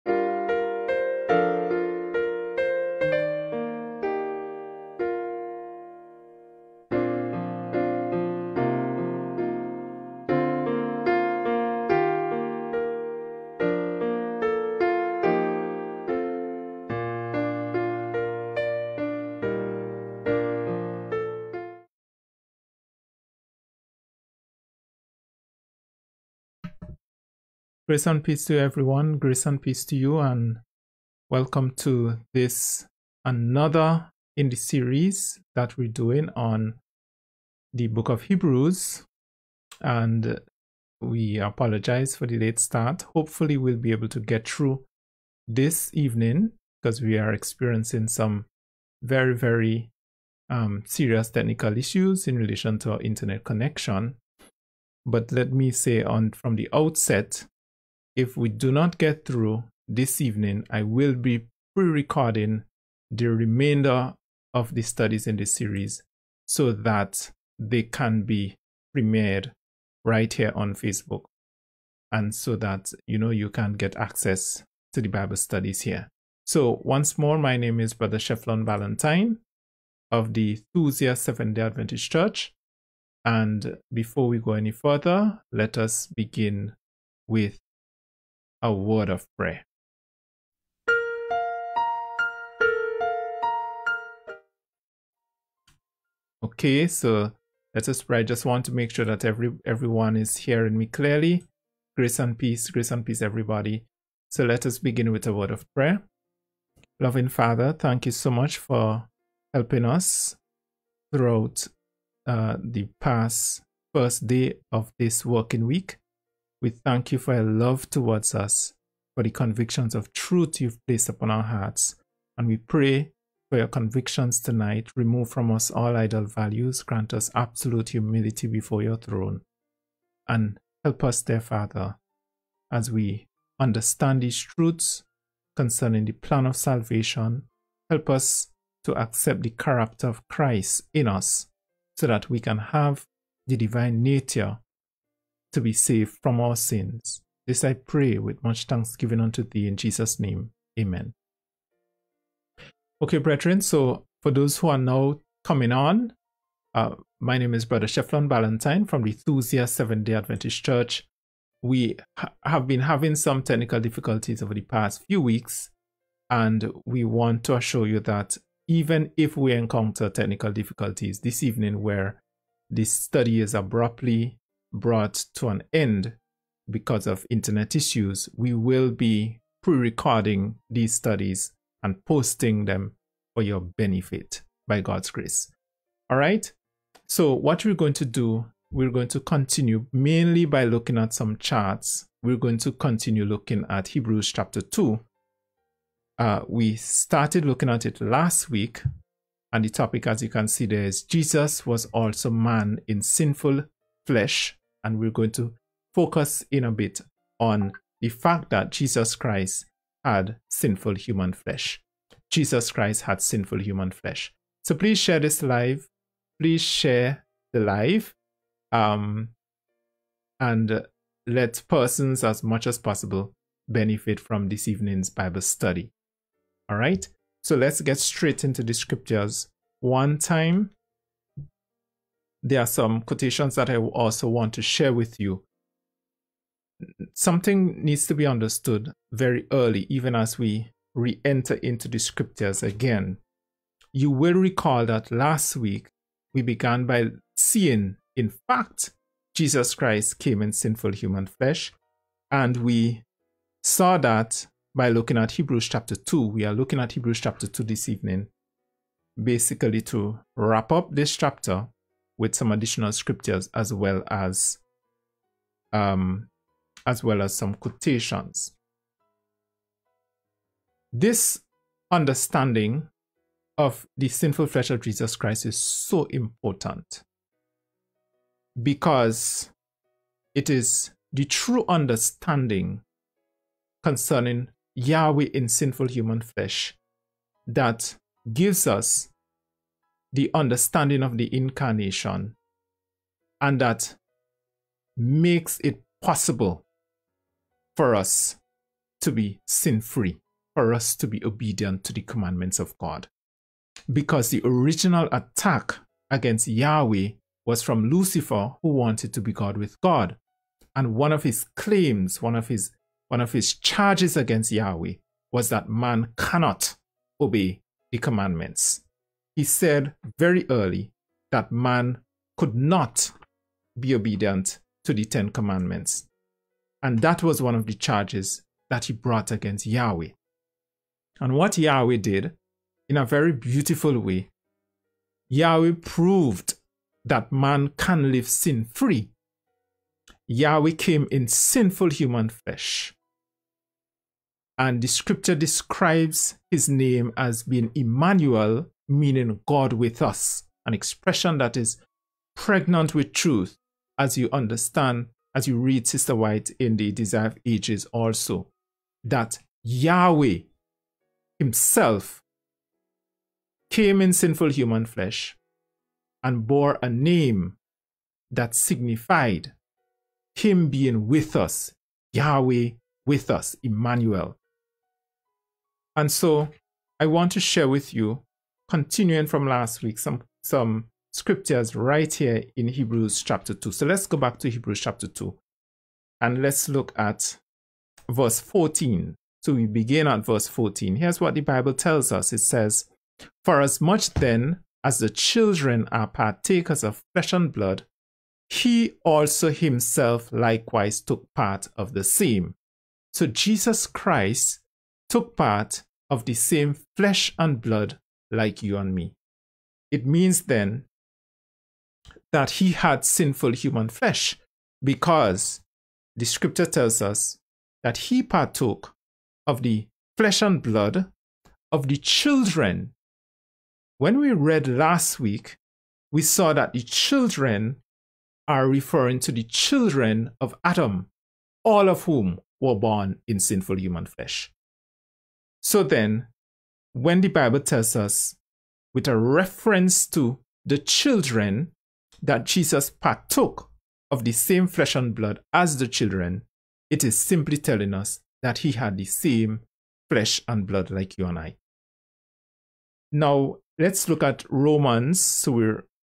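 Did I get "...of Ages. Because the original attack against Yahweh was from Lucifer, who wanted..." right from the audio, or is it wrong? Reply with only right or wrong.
wrong.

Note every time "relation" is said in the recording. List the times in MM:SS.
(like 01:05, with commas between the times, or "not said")
00:52.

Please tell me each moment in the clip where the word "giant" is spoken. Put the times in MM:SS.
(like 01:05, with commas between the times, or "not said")
not said.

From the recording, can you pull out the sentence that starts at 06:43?
So Jesus Christ took part of the same flesh and blood like you and me.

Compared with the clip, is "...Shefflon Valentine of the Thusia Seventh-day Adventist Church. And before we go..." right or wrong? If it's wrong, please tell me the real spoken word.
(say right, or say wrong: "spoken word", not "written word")
right.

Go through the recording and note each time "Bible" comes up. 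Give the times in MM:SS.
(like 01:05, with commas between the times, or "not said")
01:15, 03:45, 06:31, 07:17.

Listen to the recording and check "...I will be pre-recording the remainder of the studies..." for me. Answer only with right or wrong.
right.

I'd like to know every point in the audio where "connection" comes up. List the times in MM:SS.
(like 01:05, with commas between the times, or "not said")
00:53.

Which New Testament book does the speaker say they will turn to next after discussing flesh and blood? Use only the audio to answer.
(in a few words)
Romans.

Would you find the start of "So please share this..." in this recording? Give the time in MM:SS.
03:34.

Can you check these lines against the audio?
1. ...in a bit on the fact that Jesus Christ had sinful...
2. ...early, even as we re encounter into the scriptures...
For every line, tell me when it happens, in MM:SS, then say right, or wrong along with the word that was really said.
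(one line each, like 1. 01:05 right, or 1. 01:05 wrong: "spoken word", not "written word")
1. 03:26 right
2. 03:59 wrong: "enter", not "encounter".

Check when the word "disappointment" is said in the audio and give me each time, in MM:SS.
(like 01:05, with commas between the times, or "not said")
not said.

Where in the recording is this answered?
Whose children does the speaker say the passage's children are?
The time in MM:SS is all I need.
07:09.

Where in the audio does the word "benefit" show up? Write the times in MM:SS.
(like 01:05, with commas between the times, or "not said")
03:03, 03:43.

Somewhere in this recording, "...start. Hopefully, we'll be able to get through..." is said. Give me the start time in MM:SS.
00:42.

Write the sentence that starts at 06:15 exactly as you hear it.
And so I want to share with you continuing from last week, some, some scriptures right here in Hebrews chapter 2.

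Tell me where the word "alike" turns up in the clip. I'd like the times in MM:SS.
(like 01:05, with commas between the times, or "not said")
not said.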